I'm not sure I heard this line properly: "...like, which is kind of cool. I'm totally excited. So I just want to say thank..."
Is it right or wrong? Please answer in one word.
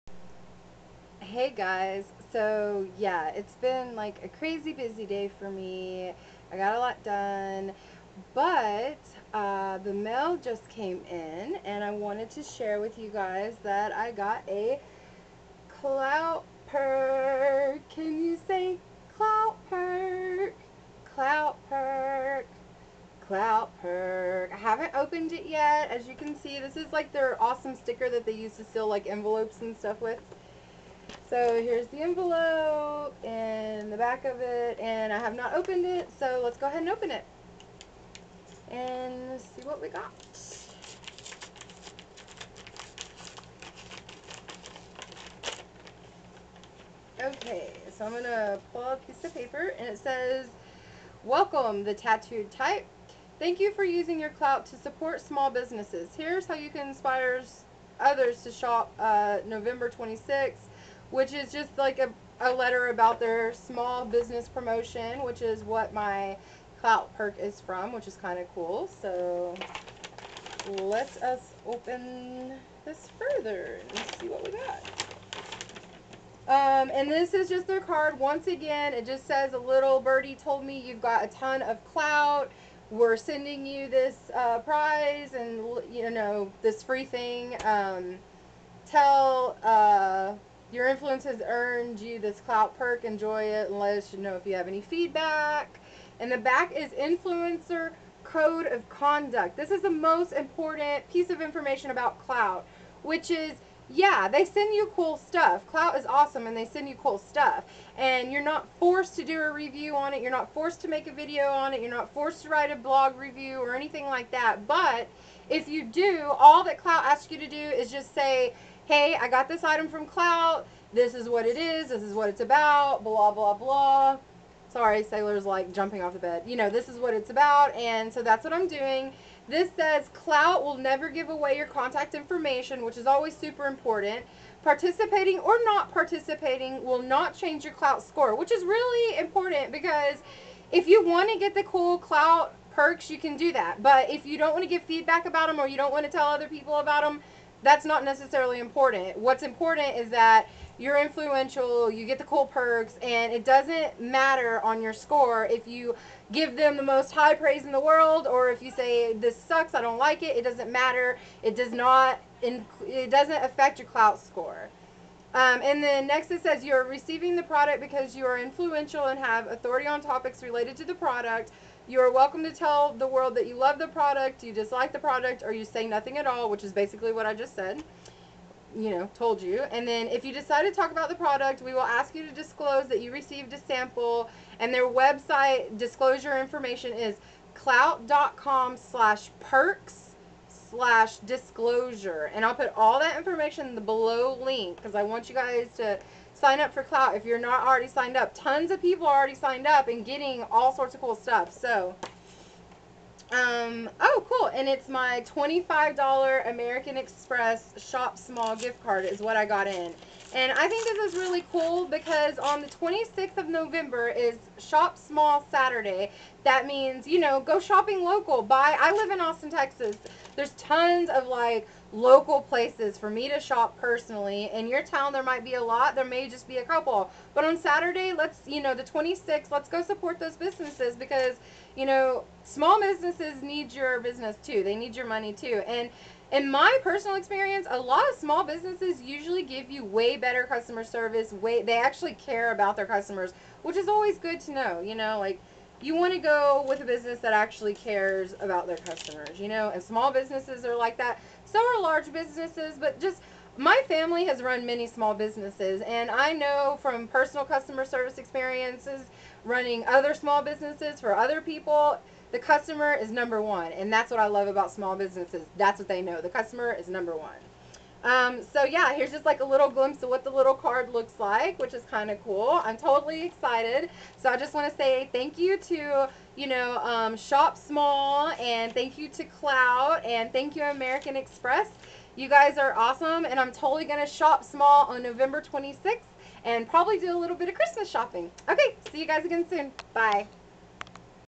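right.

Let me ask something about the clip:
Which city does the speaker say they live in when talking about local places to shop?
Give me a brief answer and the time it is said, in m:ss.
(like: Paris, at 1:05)
Austin, Texas, at 3:39.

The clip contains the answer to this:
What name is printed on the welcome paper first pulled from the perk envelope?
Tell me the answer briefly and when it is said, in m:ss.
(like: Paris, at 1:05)
The Tattooed Type, at 0:51.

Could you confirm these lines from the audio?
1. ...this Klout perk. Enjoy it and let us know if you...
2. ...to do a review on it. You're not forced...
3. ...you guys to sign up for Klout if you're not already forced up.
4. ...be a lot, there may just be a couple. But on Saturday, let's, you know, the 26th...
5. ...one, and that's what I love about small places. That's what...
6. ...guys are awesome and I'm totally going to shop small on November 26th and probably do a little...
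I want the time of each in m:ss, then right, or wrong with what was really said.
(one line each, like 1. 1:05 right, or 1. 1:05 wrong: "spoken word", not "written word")
1. 1:32 right
2. 1:49 right
3. 3:15 wrong: "signed", not "forced"
4. 3:45 right
5. 4:23 wrong: "businesses", not "places"
6. 4:42 right.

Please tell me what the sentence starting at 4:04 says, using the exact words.
You know, like you want to go with a business that actually cares about their customers.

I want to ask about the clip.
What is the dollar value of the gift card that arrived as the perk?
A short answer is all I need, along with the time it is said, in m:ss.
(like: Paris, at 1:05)
$25, at 3:25.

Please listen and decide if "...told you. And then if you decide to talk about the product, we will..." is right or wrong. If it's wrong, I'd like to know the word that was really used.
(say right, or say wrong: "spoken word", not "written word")
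right.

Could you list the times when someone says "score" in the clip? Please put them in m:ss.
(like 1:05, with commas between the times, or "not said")
2:18, 2:34, 2:44.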